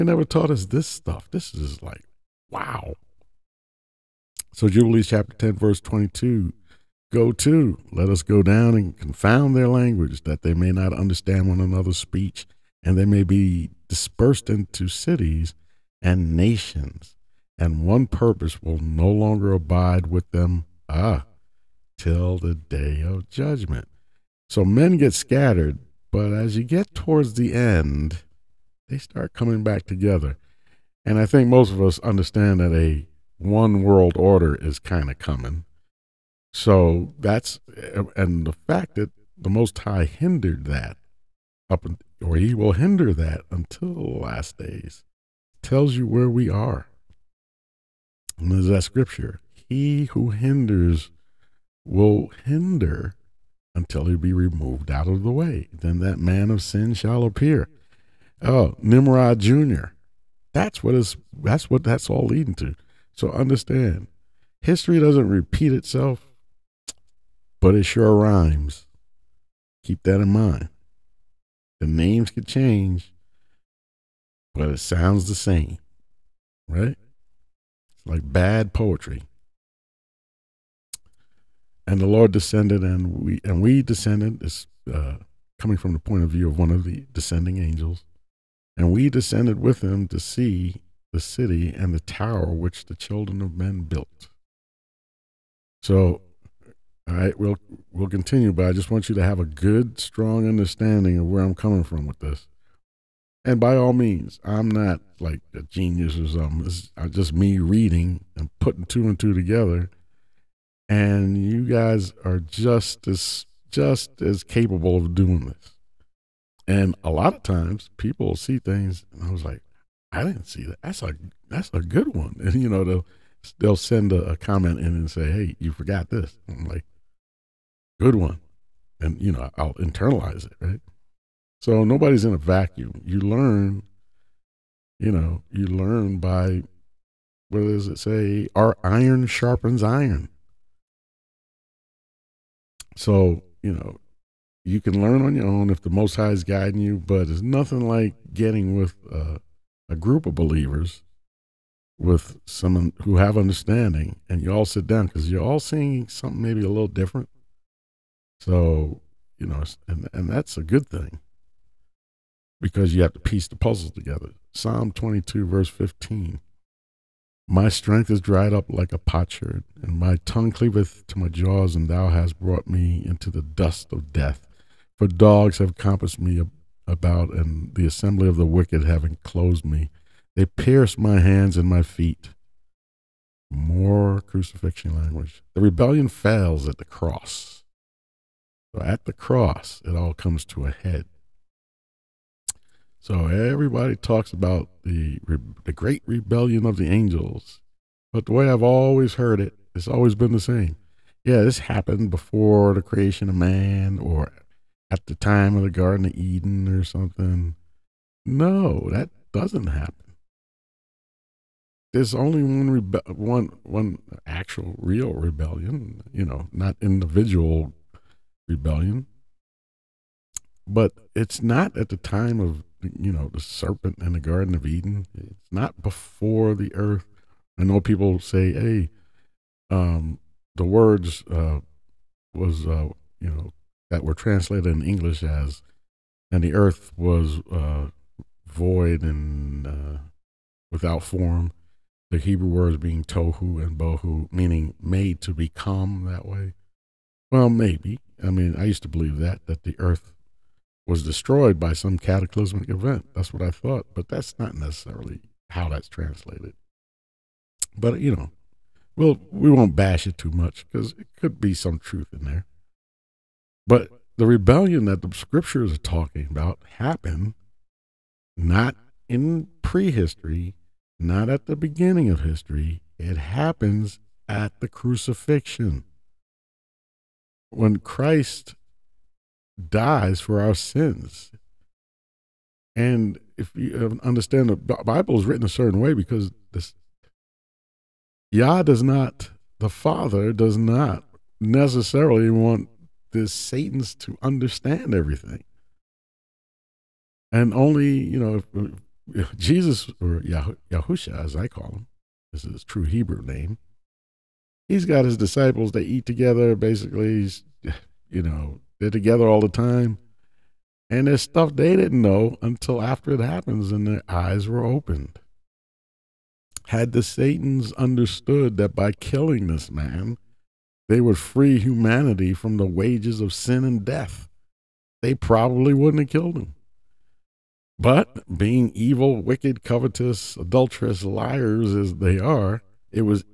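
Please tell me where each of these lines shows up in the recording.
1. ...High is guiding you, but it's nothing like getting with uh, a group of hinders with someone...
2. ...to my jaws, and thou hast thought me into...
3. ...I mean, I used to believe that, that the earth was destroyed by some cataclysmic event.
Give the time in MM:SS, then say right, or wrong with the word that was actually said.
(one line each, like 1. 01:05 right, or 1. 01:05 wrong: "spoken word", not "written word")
1. 02:26 wrong: "believers", not "hinders"
2. 02:51 wrong: "brought", not "thought"
3. 04:08 right.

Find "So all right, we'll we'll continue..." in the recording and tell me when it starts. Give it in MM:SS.
01:35.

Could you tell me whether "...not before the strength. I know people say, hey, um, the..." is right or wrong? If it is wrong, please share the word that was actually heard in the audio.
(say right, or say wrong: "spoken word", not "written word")
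wrong: "earth", not "strength".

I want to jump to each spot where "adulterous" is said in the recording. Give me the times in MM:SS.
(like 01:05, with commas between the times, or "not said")
05:30.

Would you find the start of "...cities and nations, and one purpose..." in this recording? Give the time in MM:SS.
00:14.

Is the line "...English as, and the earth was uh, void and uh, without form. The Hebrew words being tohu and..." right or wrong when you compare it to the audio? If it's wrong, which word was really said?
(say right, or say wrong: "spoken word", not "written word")
right.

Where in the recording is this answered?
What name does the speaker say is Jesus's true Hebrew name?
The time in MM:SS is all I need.
05:00.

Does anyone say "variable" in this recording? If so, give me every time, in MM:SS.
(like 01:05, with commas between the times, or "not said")
not said.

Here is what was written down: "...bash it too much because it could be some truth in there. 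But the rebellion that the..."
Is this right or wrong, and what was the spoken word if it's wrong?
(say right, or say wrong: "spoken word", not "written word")
right.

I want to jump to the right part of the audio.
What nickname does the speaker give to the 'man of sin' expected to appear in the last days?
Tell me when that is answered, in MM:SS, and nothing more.
00:58.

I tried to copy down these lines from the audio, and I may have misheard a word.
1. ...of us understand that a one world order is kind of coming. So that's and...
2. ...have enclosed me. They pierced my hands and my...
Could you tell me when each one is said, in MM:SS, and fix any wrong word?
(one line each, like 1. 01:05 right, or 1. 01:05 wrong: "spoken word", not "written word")
1. 00:31 right
2. 02:58 right.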